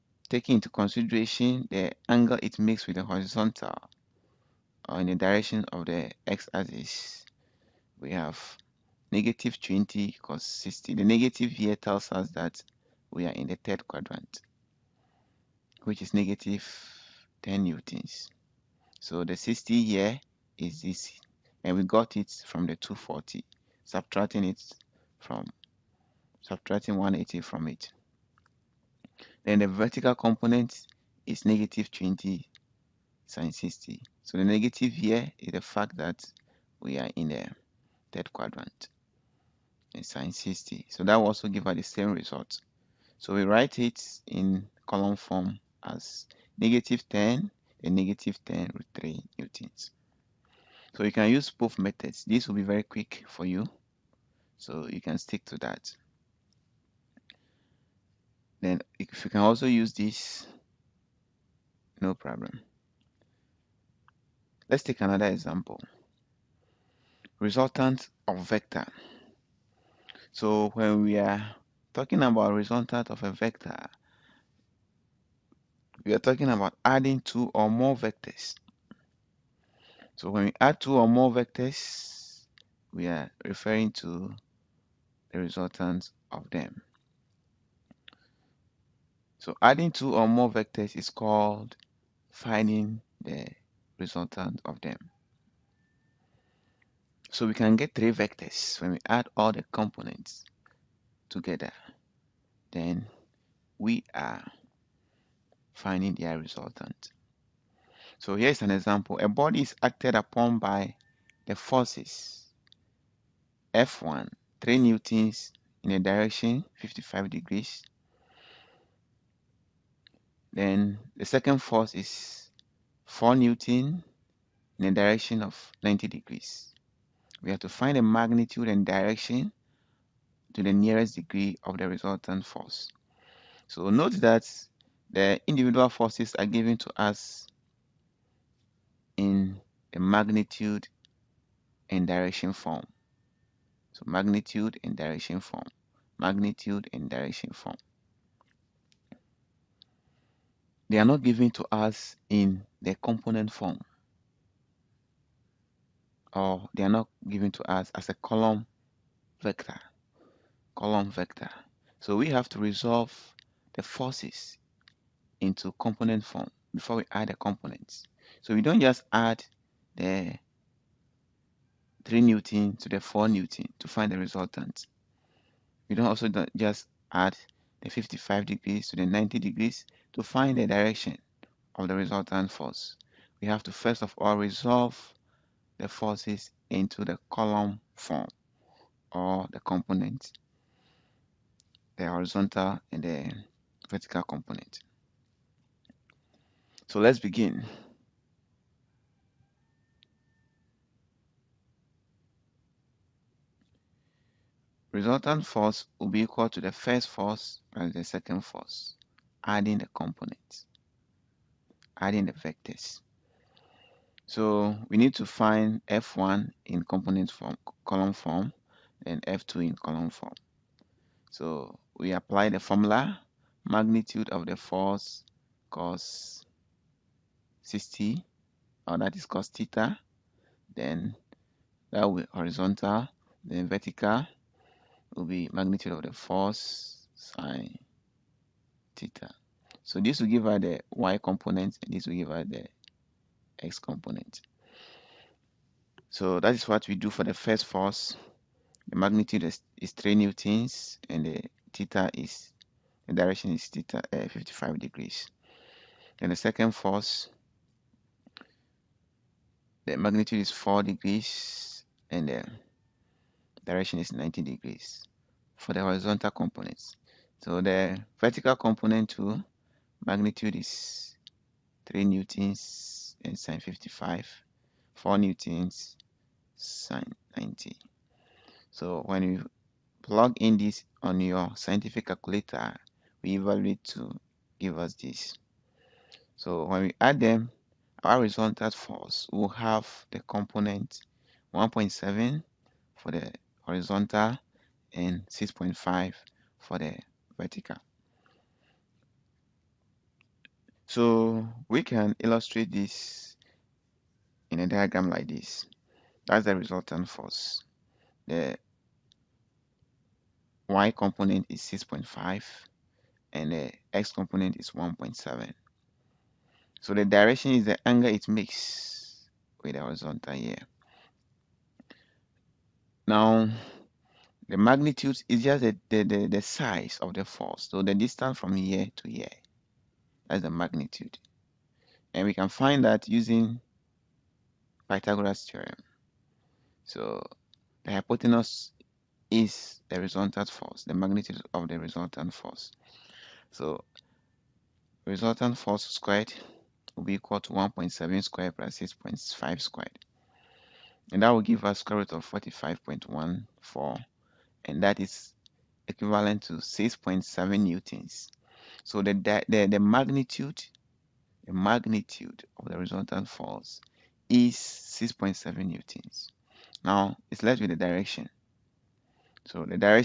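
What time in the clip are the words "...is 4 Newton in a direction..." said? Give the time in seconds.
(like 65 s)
121 s.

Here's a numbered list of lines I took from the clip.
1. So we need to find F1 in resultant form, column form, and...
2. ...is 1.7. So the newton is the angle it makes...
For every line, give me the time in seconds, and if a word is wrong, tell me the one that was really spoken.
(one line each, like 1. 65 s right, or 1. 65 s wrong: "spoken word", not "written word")
1. 214 s wrong: "component", not "resultant"
2. 314 s wrong: "direction", not "newton".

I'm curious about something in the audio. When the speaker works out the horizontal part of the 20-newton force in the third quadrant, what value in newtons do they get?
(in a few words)
-10 newtons.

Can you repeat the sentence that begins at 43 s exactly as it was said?
So we write it in column form as negative 10 and negative 10 root 3 newtons.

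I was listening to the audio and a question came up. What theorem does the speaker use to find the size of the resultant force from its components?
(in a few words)
Pythagoras theorem.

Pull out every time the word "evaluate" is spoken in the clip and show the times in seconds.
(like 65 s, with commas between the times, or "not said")
283 s.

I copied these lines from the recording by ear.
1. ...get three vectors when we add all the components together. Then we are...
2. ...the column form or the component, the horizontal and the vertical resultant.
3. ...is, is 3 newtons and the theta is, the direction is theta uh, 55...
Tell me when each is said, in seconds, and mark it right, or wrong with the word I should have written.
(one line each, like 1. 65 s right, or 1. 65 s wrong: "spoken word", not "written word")
1. 97 s right
2. 187 s wrong: "component", not "resultant"
3. 249 s right.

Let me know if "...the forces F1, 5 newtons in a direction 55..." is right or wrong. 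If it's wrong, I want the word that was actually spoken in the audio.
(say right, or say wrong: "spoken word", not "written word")
wrong: "3", not "5".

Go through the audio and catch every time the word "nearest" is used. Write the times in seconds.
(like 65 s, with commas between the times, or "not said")
130 s.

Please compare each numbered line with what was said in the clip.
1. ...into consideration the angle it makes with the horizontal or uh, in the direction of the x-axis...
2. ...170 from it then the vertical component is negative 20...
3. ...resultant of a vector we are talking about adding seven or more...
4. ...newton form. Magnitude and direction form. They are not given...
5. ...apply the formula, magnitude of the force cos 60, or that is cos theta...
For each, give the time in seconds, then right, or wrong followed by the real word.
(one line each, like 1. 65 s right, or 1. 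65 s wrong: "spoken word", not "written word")
1. 0 s right
2. 26 s wrong: "180", not "170"
3. 72 s wrong: "two", not "seven"
4. 144 s wrong: "direction", not "newton"
5. 222 s right.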